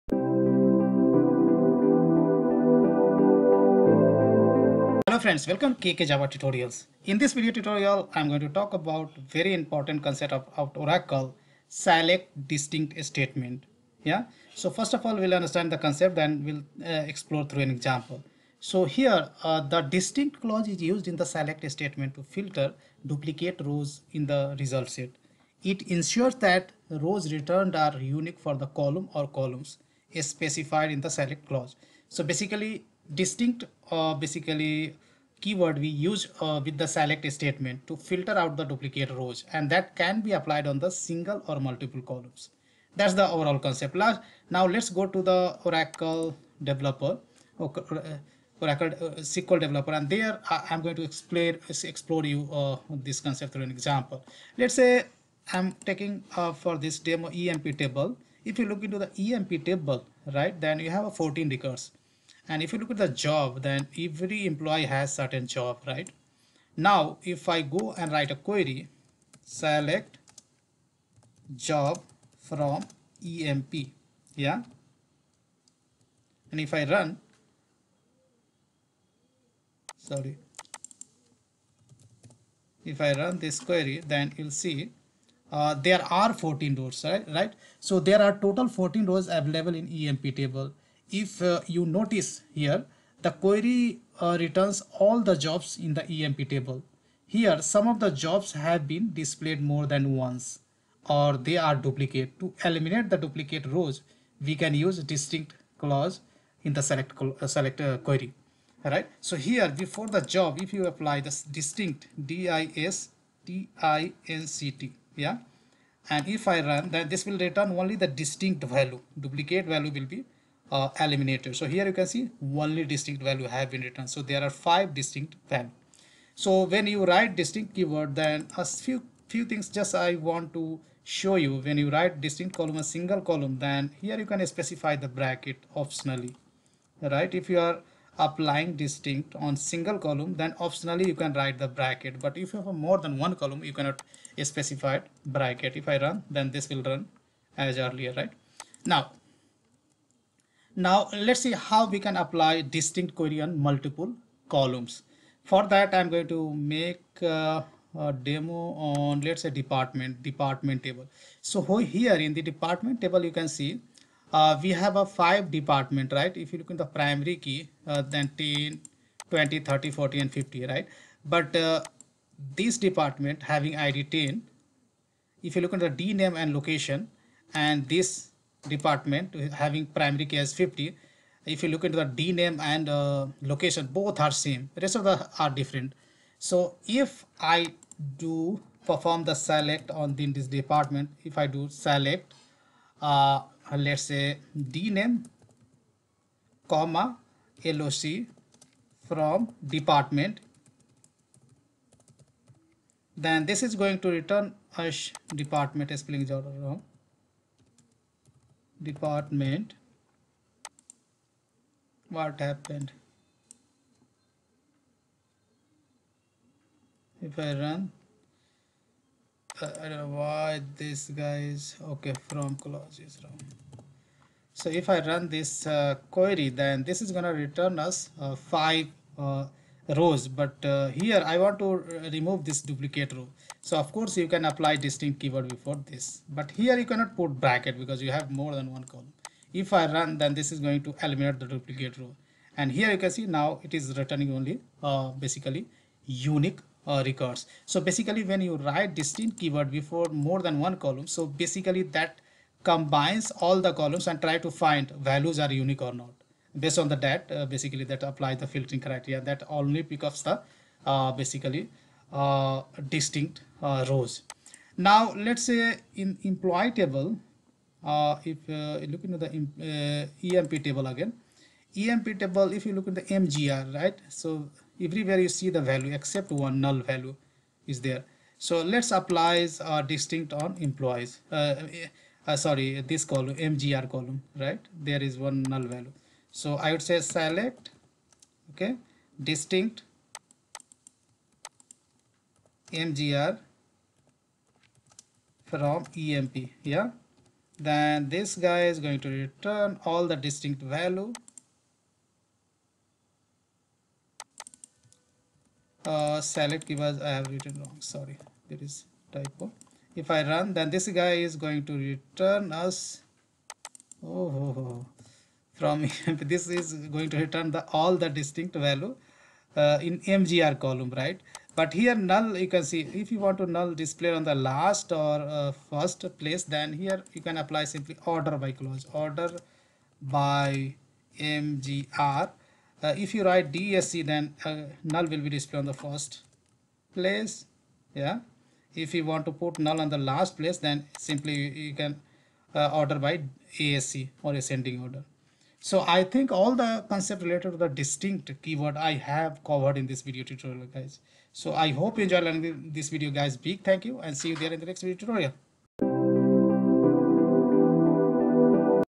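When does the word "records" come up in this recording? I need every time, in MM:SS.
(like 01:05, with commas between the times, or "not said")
01:01, 04:07.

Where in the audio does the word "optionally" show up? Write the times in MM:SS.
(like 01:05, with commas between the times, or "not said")
02:15, 02:20.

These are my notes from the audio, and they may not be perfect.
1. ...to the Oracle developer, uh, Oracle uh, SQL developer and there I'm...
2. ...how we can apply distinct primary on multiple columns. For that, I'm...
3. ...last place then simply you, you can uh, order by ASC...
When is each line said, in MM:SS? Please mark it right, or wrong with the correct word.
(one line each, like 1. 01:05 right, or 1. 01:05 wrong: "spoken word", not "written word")
1. 00:45 right
2. 02:31 wrong: "query", not "primary"
3. 05:39 right.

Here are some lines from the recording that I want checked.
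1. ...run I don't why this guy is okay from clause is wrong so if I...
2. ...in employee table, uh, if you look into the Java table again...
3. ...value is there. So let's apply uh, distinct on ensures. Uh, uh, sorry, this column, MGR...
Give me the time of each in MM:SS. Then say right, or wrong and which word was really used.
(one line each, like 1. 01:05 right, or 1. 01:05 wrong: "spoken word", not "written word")
1. 03:37 right
2. 04:25 wrong: "EMP", not "Java"
3. 04:36 wrong: "employees", not "ensures".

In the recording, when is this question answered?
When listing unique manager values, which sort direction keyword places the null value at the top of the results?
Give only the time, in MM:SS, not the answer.
05:33.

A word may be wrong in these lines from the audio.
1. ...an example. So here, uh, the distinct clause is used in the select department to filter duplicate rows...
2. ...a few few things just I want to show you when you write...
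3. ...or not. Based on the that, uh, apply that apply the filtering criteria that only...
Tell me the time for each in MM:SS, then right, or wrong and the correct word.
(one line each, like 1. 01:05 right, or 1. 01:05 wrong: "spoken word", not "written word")
1. 00:17 wrong: "statement", not "department"
2. 02:08 right
3. 04:15 wrong: "basically", not "apply".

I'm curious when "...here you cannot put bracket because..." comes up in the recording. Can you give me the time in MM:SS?
03:56.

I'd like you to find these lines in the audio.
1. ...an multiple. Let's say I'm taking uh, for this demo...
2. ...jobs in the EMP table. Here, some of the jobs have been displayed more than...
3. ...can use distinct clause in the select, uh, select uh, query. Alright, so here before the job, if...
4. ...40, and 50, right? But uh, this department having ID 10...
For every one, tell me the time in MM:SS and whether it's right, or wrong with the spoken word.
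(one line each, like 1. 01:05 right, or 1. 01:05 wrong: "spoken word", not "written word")
1. 00:53 wrong: "example", not "multiple"
2. 01:35 right
3. 01:44 right
4. 02:49 right.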